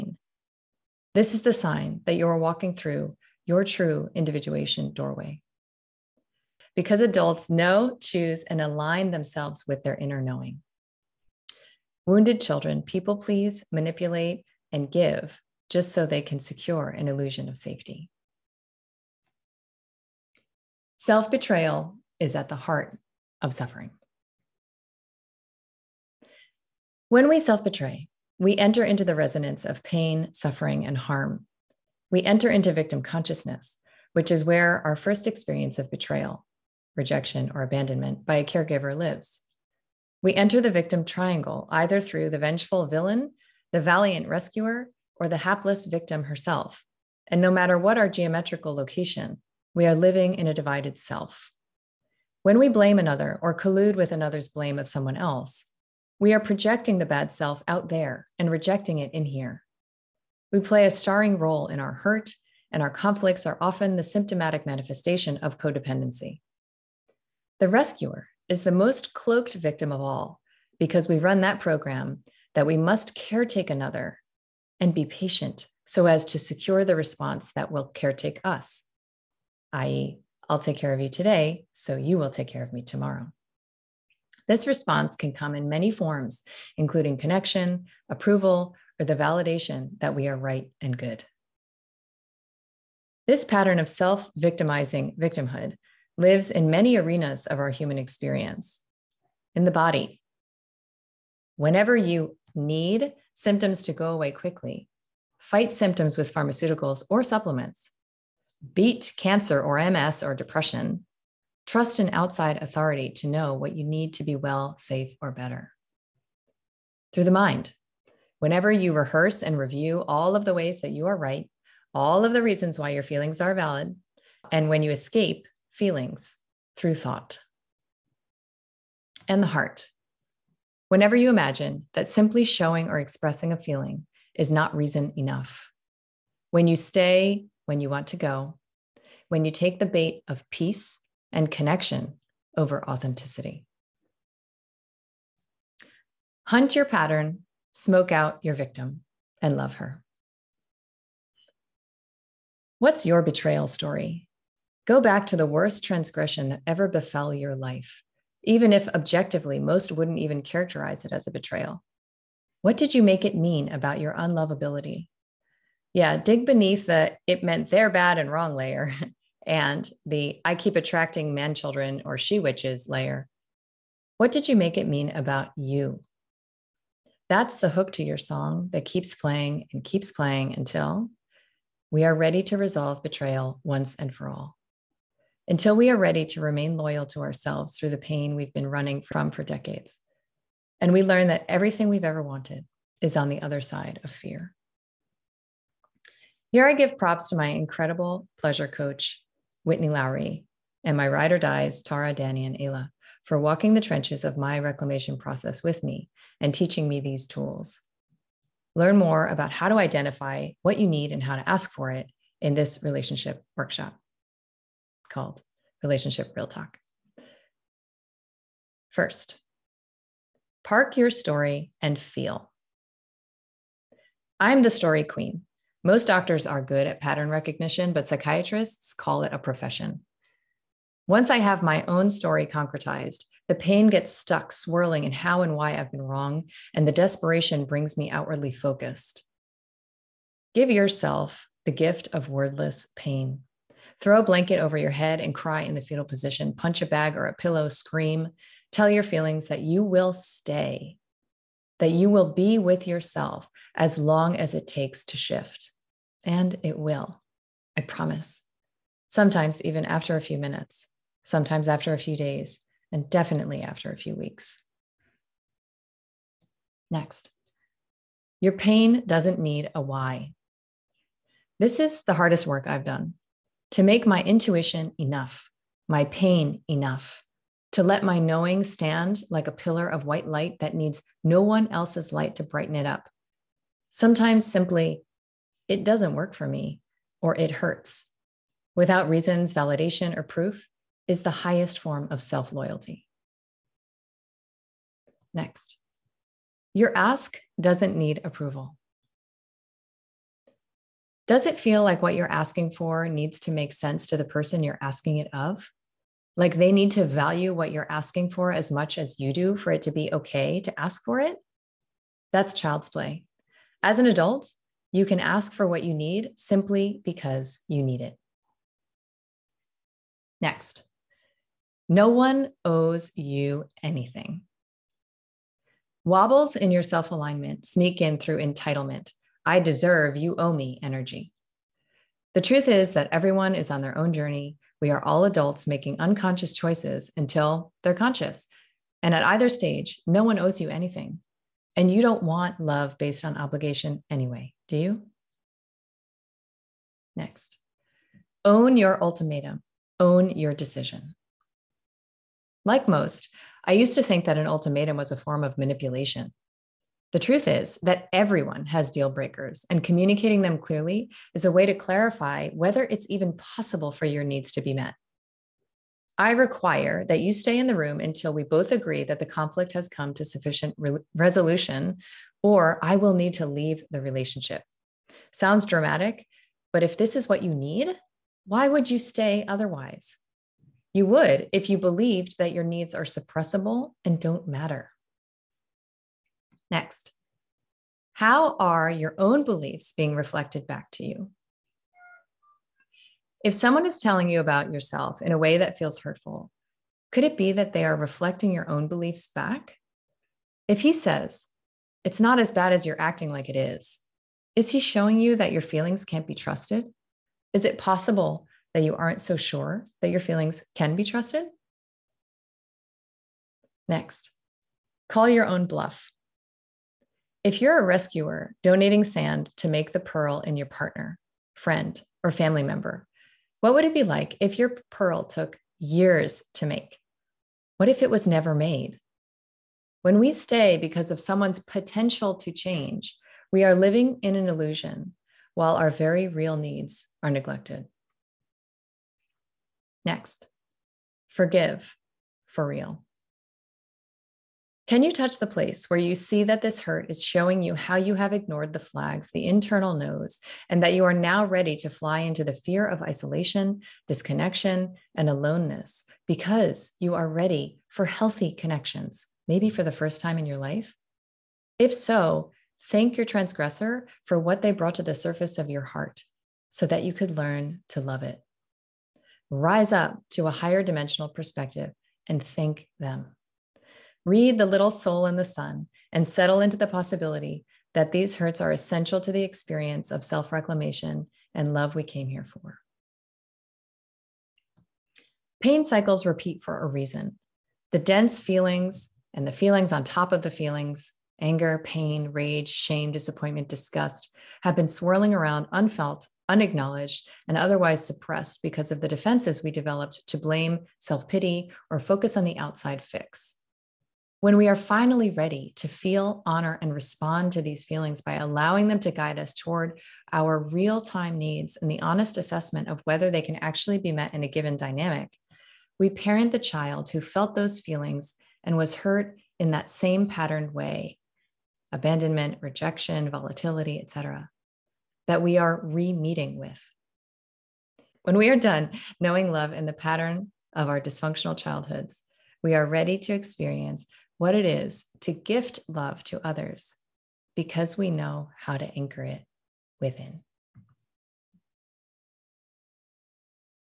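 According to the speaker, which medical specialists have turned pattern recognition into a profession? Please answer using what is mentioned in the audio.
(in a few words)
psychiatrists.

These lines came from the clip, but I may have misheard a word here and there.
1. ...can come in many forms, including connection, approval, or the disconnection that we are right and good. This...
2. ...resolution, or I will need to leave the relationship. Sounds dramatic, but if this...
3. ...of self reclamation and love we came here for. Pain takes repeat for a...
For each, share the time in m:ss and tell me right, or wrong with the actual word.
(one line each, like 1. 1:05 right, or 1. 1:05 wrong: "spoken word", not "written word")
1. 1:25 wrong: "validation", not "disconnection"
2. 6:11 right
3. 8:00 wrong: "cycles", not "takes".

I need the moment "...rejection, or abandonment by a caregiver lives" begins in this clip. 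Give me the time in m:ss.
0:36.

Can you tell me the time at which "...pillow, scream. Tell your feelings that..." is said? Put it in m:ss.
4:07.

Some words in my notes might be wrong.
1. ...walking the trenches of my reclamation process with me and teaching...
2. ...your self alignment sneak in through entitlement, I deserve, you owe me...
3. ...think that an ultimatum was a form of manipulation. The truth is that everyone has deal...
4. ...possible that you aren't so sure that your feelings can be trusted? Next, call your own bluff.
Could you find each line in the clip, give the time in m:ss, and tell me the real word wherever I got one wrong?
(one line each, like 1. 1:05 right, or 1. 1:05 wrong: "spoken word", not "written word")
1. 3:23 right
2. 5:26 right
3. 5:54 right
4. 6:47 right.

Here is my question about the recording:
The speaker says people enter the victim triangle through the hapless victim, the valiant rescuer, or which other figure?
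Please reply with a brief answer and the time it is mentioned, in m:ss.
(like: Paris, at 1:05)
the vengeful villain, at 0:42.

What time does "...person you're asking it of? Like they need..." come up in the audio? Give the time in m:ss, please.
5:04.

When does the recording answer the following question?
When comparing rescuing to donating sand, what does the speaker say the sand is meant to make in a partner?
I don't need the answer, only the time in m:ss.
6:59.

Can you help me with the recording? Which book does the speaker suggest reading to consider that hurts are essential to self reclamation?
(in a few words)
The Little Soul and the Sun.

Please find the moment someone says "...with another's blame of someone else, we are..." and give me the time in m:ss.
0:53.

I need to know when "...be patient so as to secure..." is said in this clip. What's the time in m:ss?
1:14.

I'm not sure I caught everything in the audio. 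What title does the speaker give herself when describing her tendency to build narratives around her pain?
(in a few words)
the story queen.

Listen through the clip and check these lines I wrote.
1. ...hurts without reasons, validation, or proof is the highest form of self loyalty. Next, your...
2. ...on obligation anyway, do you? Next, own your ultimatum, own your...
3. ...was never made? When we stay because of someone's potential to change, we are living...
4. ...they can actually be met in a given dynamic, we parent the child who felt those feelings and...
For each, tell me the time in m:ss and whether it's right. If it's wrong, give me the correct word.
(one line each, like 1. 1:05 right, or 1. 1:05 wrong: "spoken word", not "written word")
1. 4:47 right
2. 5:43 right
3. 7:08 right
4. 8:33 right.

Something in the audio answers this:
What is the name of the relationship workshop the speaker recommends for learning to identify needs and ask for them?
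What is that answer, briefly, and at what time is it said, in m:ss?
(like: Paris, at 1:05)
Relationship Real Talk, at 3:35.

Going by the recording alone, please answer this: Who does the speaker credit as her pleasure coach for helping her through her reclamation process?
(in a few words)
Whitney Lowry.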